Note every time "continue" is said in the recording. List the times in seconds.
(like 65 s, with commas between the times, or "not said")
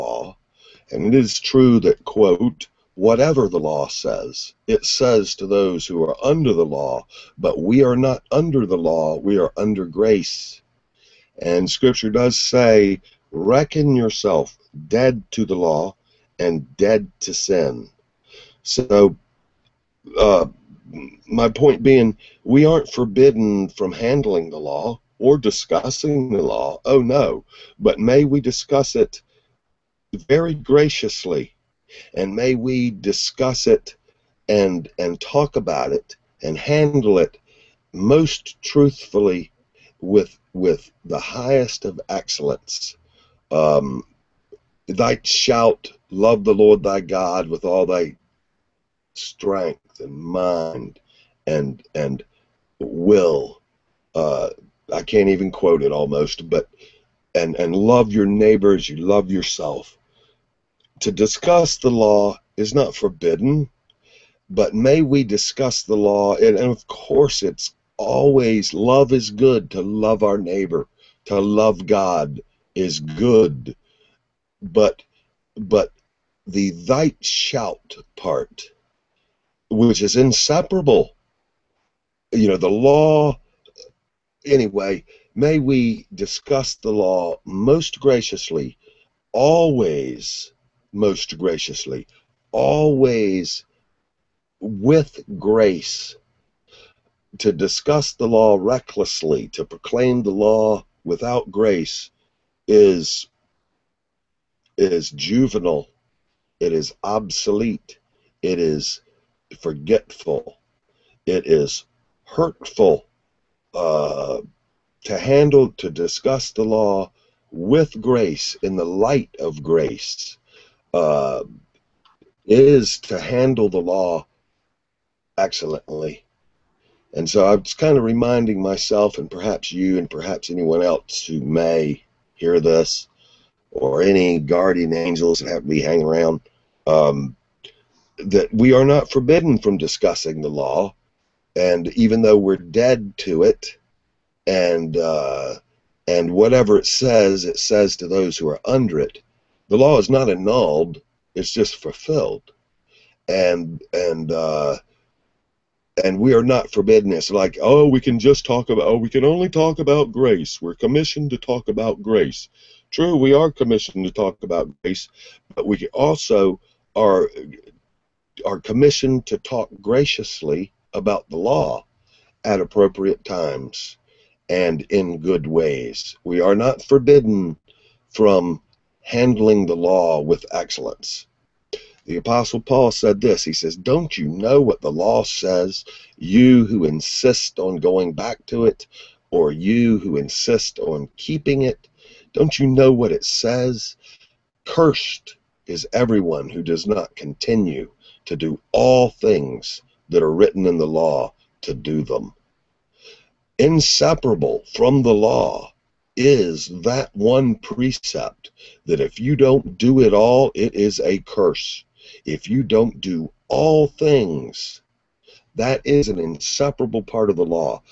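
197 s.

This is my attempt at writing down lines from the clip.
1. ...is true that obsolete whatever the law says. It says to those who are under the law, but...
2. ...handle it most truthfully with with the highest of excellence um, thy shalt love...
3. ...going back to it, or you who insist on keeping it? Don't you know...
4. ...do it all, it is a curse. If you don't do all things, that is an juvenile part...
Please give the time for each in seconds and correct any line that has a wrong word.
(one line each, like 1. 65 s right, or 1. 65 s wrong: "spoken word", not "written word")
1. 1 s wrong: "quote", not "obsolete"
2. 36 s right
3. 187 s right
4. 209 s wrong: "inseparable", not "juvenile".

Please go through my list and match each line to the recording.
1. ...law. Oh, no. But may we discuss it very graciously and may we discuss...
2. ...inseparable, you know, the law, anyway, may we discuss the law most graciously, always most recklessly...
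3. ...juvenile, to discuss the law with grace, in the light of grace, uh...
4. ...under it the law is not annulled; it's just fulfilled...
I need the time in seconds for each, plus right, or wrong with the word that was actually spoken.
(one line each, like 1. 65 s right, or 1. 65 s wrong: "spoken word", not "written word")
1. 26 s right
2. 80 s wrong: "graciously", not "recklessly"
3. 115 s wrong: "handle", not "juvenile"
4. 148 s right.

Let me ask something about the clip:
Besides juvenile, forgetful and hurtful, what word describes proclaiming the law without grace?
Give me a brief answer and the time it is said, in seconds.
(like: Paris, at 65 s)
obsolete, at 107 s.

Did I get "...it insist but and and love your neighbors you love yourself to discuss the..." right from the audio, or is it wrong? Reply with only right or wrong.
wrong.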